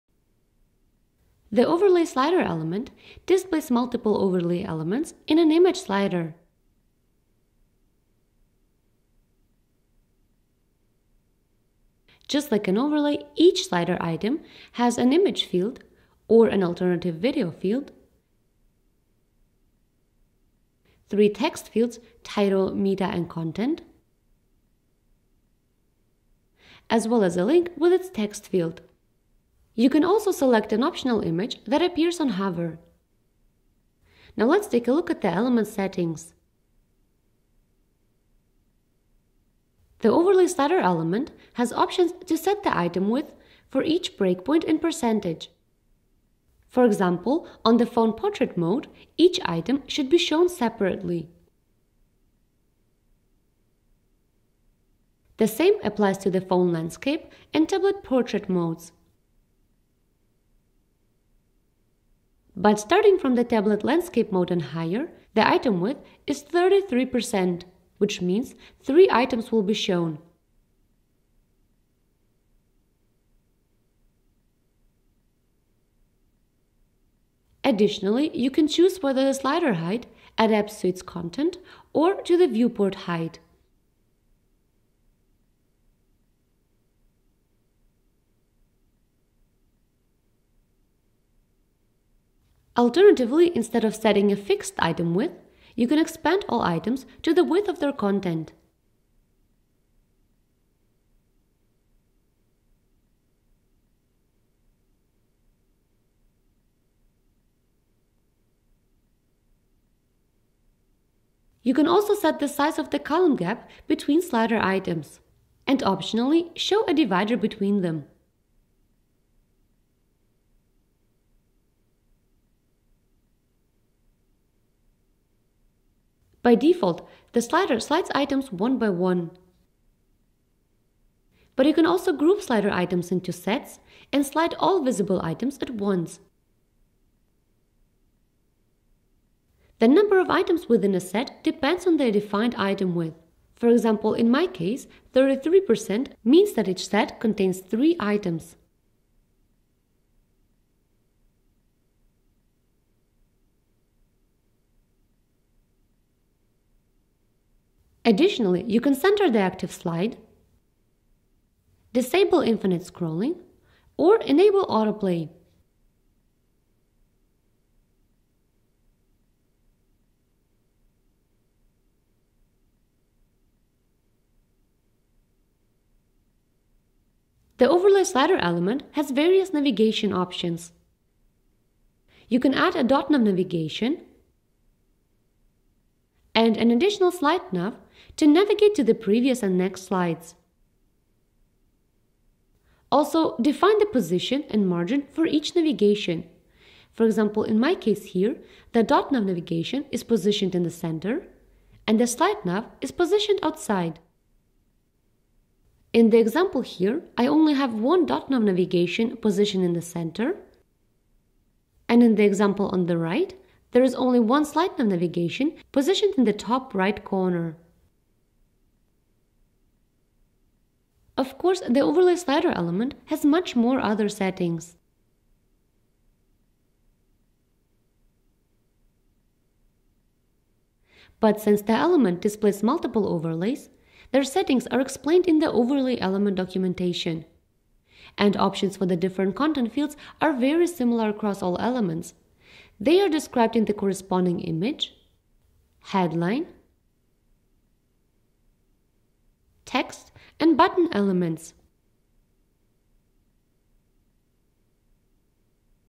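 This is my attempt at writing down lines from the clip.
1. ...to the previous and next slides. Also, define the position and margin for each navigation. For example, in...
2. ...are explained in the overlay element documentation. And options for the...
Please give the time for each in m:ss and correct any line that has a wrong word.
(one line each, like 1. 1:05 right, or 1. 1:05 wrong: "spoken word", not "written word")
1. 3:08 right
2. 3:54 right.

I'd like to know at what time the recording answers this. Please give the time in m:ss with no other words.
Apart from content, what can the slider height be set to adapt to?
1:22.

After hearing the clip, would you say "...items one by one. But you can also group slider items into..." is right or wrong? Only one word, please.
right.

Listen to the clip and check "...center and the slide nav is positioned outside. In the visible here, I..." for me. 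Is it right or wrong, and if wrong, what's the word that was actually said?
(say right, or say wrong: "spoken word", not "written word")
wrong: "example", not "visible".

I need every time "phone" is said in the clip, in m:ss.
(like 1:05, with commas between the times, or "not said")
0:47, 0:56.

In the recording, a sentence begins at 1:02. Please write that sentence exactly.
But starting from the tablet landscape mode and higher, the item width is 33%, which means 3 items will be shown.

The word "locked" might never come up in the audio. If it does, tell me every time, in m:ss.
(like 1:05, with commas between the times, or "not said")
not said.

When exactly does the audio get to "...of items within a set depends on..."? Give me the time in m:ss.
2:20.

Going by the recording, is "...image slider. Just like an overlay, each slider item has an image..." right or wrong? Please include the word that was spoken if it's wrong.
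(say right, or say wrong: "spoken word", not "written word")
right.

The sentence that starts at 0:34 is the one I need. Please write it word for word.
Now let's take a look at the element settings.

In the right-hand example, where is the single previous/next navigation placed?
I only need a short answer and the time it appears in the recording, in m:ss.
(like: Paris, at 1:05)
top right corner, at 3:36.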